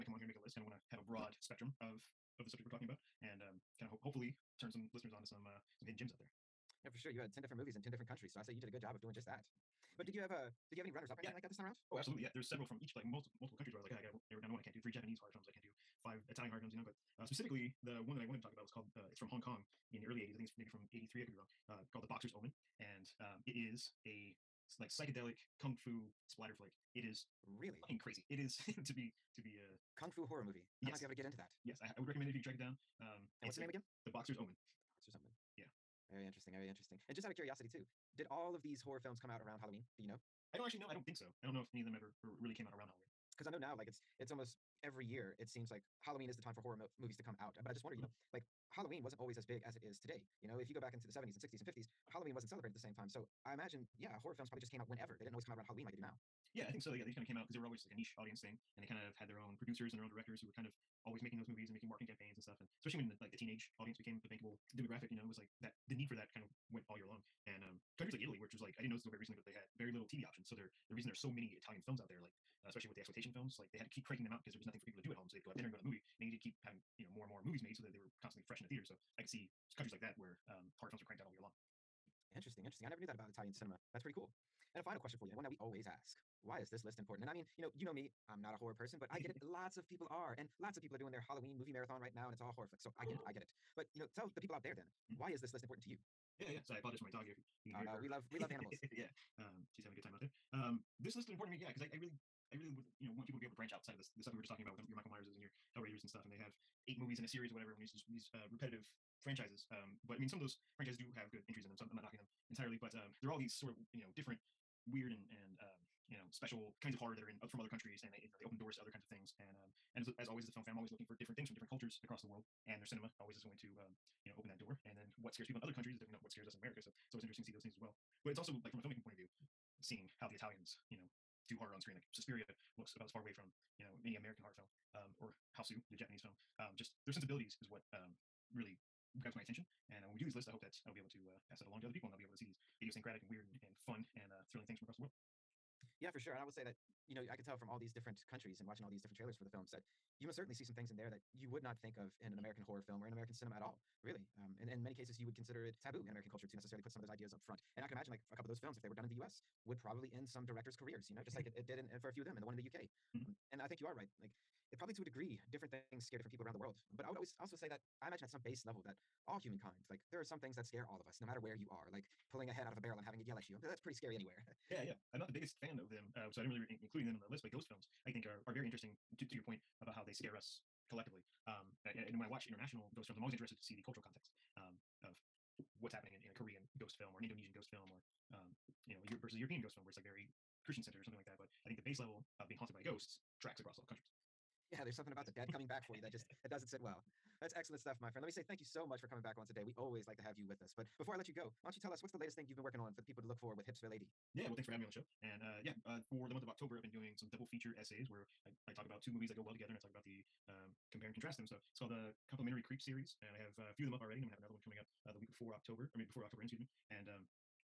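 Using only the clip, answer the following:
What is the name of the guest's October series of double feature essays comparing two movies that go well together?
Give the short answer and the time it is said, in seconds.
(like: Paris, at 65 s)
Complementary Creep, at 212 s.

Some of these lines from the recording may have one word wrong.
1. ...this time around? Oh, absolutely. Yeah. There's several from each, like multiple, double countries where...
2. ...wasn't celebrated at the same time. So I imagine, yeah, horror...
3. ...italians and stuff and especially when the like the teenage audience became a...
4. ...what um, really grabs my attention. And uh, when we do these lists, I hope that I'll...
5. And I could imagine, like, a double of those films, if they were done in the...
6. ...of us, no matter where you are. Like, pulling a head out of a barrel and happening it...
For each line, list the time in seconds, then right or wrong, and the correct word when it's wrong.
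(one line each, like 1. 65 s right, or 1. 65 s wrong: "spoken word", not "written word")
1. 11 s wrong: "multiple", not "double"
2. 52 s right
3. 62 s wrong: "campaigns", not "italians"
4. 137 s right
5. 157 s wrong: "couple", not "double"
6. 170 s wrong: "having", not "happening".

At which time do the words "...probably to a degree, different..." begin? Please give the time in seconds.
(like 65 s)
164 s.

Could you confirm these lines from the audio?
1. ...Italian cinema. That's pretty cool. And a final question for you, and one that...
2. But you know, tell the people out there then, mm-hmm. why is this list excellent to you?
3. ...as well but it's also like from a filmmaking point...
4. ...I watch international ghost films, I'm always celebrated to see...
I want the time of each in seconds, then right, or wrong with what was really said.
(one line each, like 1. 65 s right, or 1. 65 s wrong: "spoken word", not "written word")
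1. 83 s right
2. 93 s wrong: "important", not "excellent"
3. 127 s right
4. 182 s wrong: "interested", not "celebrated".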